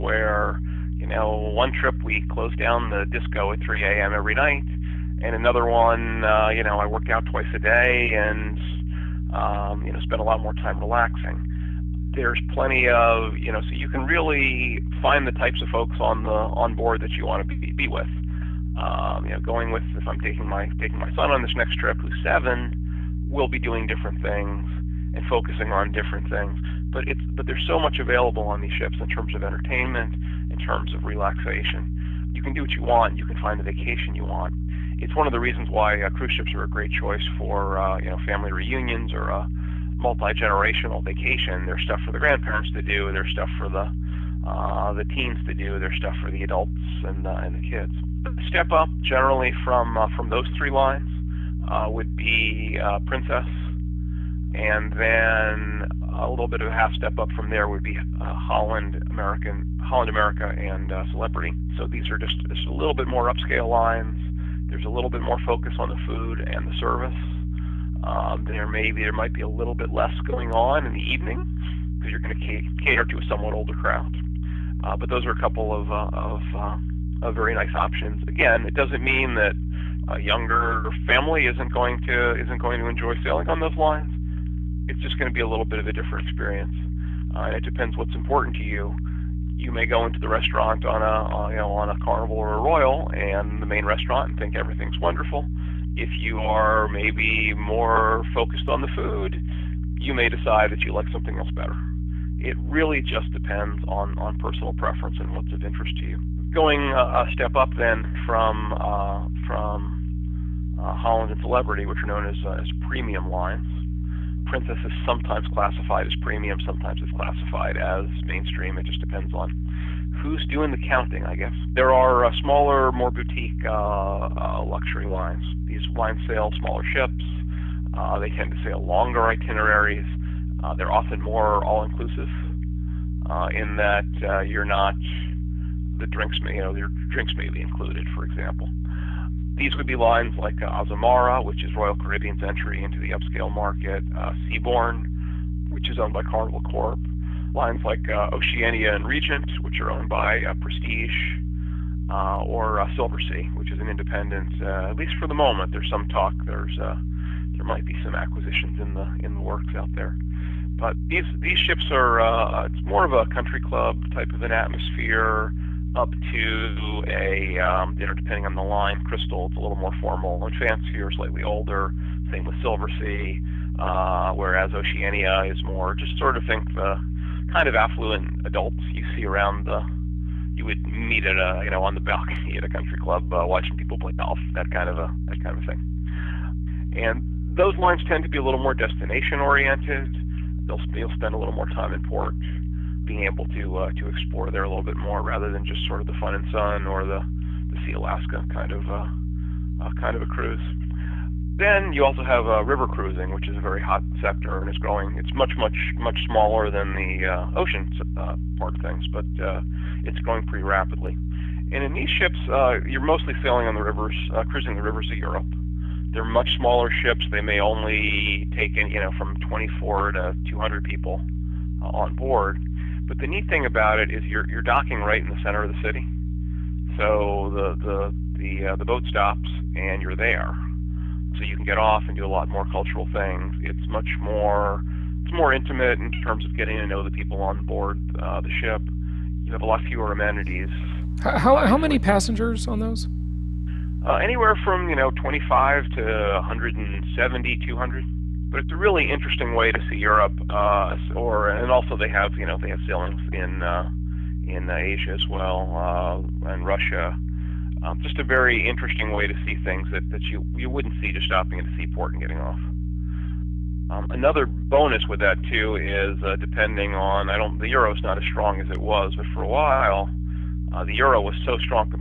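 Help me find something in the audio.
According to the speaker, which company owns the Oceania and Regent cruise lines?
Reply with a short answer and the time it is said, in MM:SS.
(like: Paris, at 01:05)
Prestige, at 02:30.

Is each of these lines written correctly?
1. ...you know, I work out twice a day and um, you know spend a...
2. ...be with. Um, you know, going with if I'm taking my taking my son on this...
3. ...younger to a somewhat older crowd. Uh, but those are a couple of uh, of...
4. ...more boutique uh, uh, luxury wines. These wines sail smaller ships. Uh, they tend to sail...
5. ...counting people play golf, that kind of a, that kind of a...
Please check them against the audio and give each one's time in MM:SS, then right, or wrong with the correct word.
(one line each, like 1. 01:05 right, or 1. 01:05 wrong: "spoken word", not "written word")
1. 00:06 right
2. 00:17 right
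3. 01:12 wrong: "cater", not "younger"
4. 02:02 right
5. 03:03 wrong: "watching", not "counting".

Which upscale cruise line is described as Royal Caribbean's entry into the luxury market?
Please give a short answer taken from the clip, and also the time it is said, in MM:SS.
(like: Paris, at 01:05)
Azamara, at 02:20.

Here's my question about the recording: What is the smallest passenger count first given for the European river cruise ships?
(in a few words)
24.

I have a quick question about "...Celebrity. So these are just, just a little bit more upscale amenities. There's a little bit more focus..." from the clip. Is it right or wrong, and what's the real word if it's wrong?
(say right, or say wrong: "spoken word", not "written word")
wrong: "lines", not "amenities".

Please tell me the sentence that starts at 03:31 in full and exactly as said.
And in these ships, uh, you're mostly sailing on the rivers, uh, cruising the rivers of Europe.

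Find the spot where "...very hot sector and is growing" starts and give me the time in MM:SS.
03:23.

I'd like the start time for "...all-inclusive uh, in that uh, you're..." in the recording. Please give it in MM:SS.
02:11.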